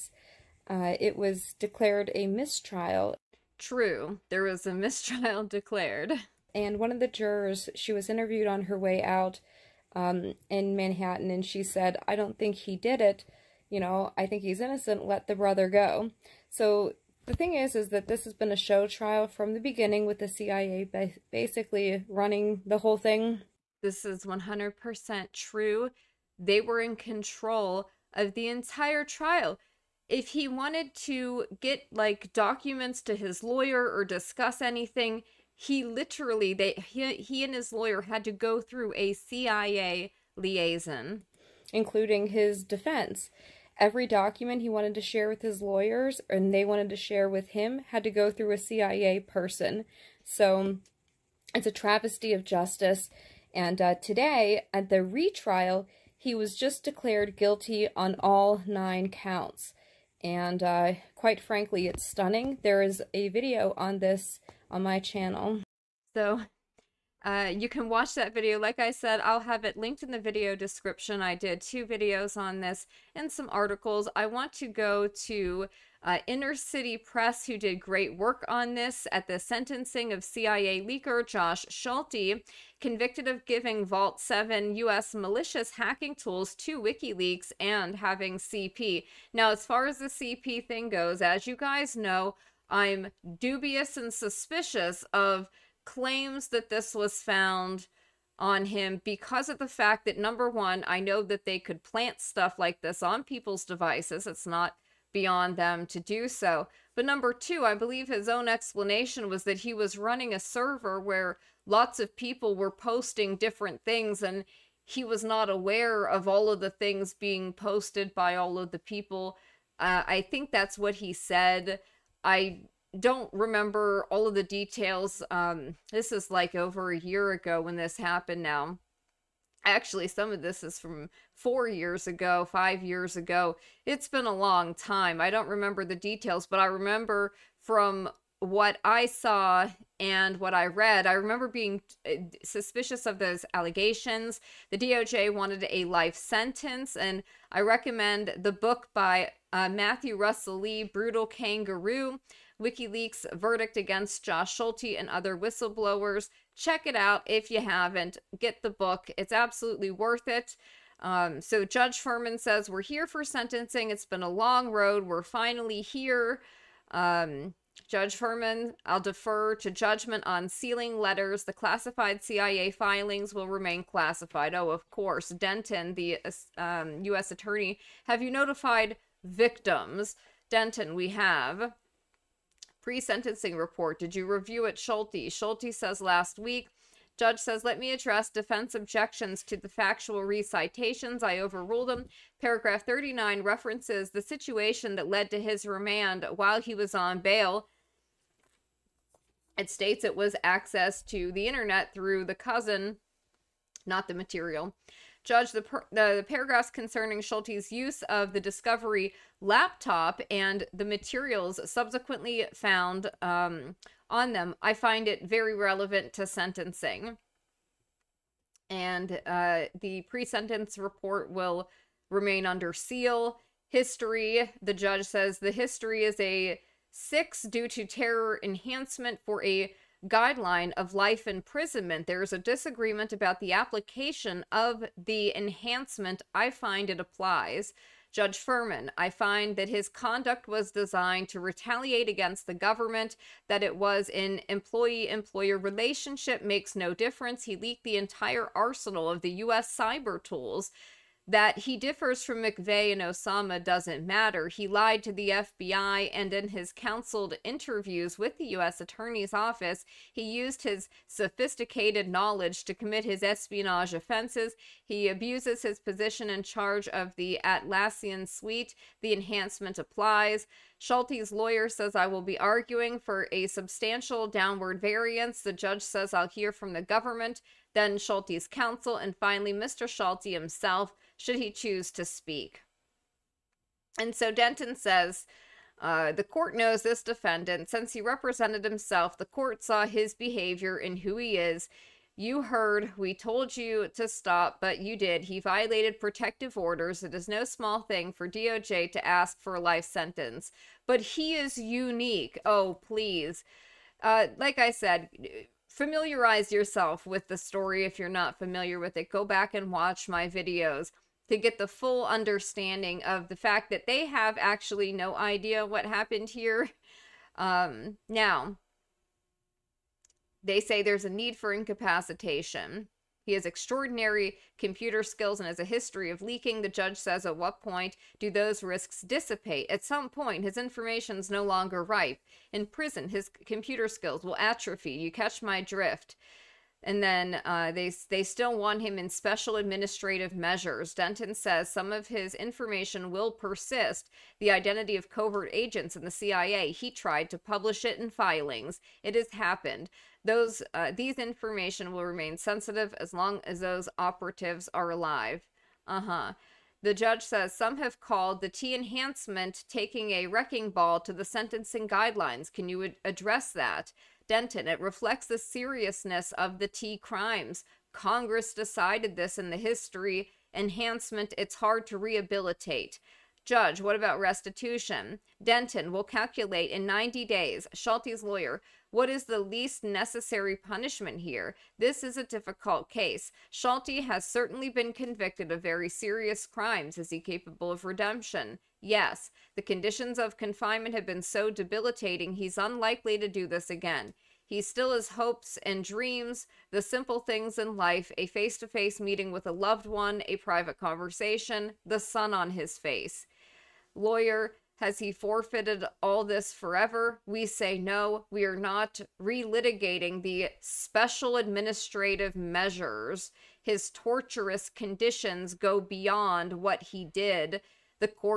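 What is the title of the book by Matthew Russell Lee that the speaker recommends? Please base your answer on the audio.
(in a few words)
Brutal Kangaroo.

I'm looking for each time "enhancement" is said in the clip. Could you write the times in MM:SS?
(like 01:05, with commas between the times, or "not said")
03:48, 03:55, 04:29, 05:58, 06:10.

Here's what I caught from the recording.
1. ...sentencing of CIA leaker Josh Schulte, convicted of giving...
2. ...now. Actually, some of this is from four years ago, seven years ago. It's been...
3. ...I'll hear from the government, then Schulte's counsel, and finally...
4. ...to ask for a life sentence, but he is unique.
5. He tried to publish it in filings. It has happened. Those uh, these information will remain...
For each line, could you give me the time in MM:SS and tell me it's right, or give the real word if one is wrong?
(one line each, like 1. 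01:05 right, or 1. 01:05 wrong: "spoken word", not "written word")
1. 01:19 right
2. 02:08 wrong: "five", not "seven"
3. 04:36 right
4. 04:58 right
5. 05:46 right.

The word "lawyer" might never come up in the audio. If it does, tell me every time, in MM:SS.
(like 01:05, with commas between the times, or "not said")
00:33, 00:37, 00:45, 04:31, 06:18, 06:43.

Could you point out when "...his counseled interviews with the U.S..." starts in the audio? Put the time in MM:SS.
04:16.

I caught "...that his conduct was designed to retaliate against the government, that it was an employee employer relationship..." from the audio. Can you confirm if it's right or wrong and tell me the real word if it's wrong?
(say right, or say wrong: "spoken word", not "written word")
right.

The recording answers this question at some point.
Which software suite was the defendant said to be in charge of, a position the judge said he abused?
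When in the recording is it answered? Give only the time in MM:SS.
04:27.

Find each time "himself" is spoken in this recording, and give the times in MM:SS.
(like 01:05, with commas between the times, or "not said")
04:40, 04:48.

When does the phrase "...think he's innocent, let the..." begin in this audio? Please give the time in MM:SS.
00:14.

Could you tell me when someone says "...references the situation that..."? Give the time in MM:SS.
03:13.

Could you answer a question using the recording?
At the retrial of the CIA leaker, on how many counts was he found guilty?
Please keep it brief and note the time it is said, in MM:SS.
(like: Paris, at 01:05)
9, at 00:58.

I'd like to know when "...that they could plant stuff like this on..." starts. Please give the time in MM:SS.
01:41.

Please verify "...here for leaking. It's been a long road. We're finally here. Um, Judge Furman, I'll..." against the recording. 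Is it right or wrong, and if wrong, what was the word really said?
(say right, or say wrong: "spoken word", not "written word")
wrong: "sentencing", not "leaking".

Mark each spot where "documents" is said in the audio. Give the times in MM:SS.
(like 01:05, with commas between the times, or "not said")
00:32, 00:44.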